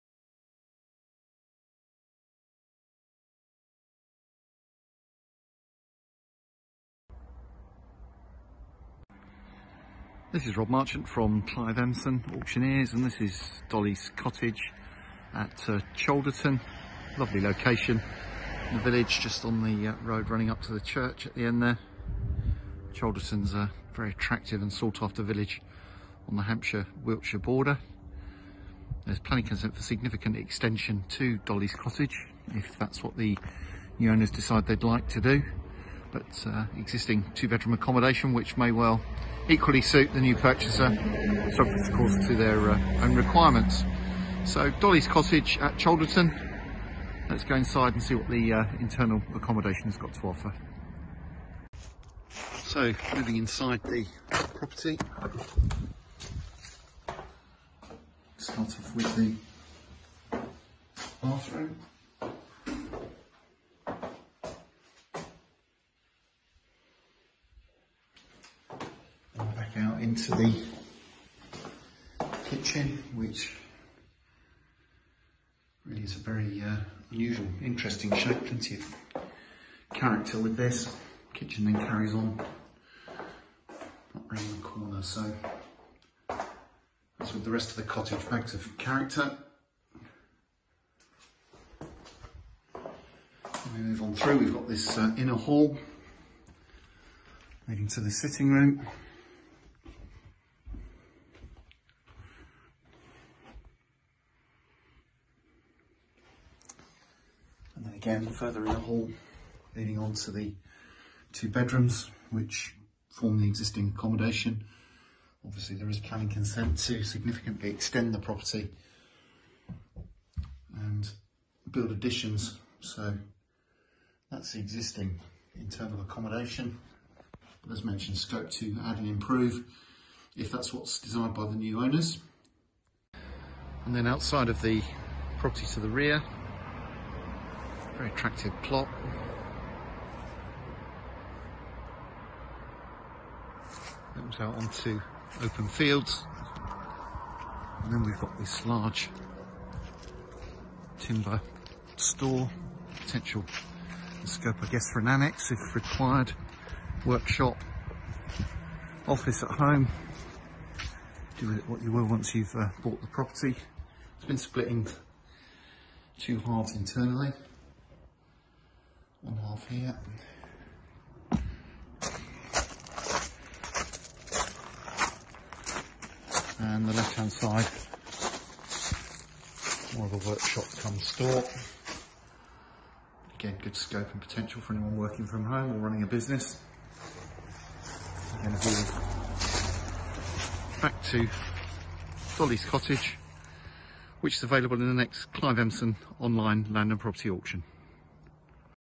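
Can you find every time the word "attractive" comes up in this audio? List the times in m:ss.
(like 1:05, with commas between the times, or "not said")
0:24, 2:18.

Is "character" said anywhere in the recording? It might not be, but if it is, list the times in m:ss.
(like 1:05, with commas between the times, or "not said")
1:19, 1:28.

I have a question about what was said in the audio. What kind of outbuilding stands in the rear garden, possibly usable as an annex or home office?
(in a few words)
large timber store.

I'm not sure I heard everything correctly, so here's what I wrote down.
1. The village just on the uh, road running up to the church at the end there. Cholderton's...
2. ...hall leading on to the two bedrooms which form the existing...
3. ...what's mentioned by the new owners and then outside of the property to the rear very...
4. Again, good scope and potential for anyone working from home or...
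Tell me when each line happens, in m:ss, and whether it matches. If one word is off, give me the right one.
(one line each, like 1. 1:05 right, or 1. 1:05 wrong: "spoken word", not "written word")
1. 0:18 right
2. 1:48 right
3. 2:10 wrong: "desired", not "mentioned"
4. 3:03 right.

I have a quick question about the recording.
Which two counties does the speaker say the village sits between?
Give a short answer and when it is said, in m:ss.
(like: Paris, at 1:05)
Hampshire-Wiltshire, at 0:26.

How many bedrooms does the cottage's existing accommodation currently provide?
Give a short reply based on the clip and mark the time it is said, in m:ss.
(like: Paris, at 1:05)
2, at 0:37.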